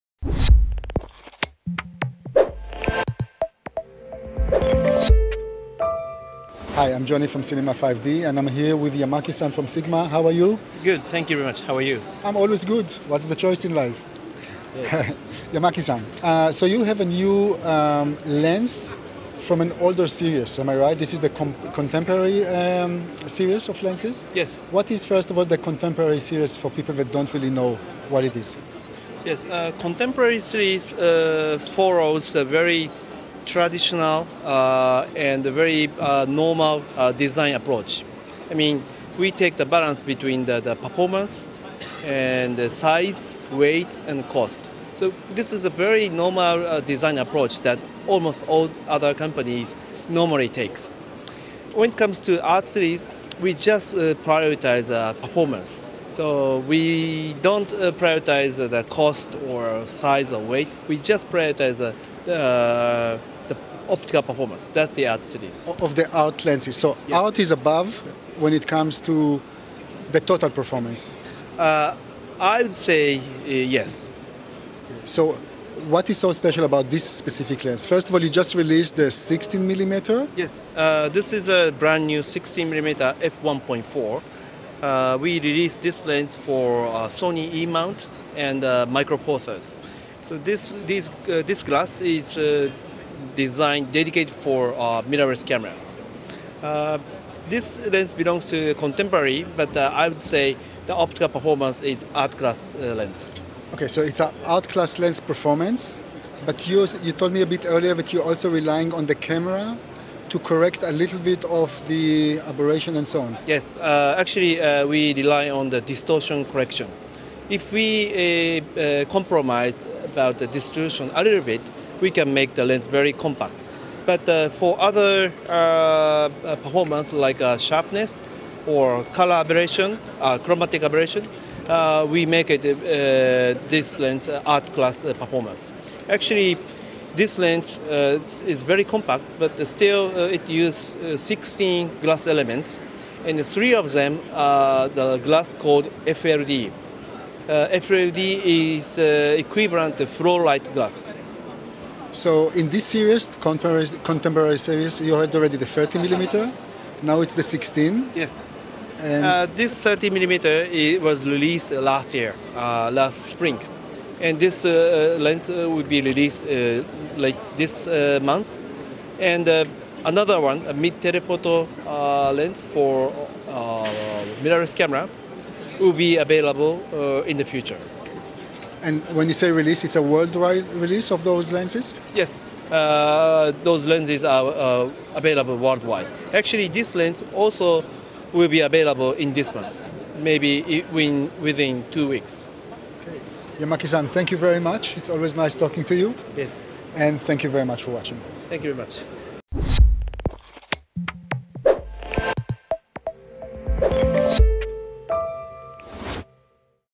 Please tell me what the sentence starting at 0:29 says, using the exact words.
Yes, uh, contemporary series uh, follows a very traditional uh, and very uh, normal uh, design approach.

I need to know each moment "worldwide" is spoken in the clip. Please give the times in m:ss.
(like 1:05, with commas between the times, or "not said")
3:00, 3:05.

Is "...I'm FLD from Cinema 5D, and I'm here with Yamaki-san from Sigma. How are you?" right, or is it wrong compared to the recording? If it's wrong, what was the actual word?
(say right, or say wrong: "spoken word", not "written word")
wrong: "Johnny", not "FLD".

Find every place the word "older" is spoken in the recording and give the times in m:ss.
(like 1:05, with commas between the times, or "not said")
0:19.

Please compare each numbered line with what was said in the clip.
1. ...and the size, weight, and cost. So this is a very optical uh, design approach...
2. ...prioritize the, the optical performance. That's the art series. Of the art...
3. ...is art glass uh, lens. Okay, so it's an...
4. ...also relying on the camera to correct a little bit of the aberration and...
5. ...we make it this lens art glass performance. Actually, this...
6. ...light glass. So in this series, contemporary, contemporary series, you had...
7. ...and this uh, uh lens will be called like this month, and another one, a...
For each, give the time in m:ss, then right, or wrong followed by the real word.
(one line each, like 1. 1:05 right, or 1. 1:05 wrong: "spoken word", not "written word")
1. 0:42 wrong: "normal", not "optical"
2. 1:01 right
3. 1:41 wrong: "class", not "glass"
4. 1:48 right
5. 2:12 wrong: "class", not "glass"
6. 2:30 right
7. 2:44 wrong: "released", not "called".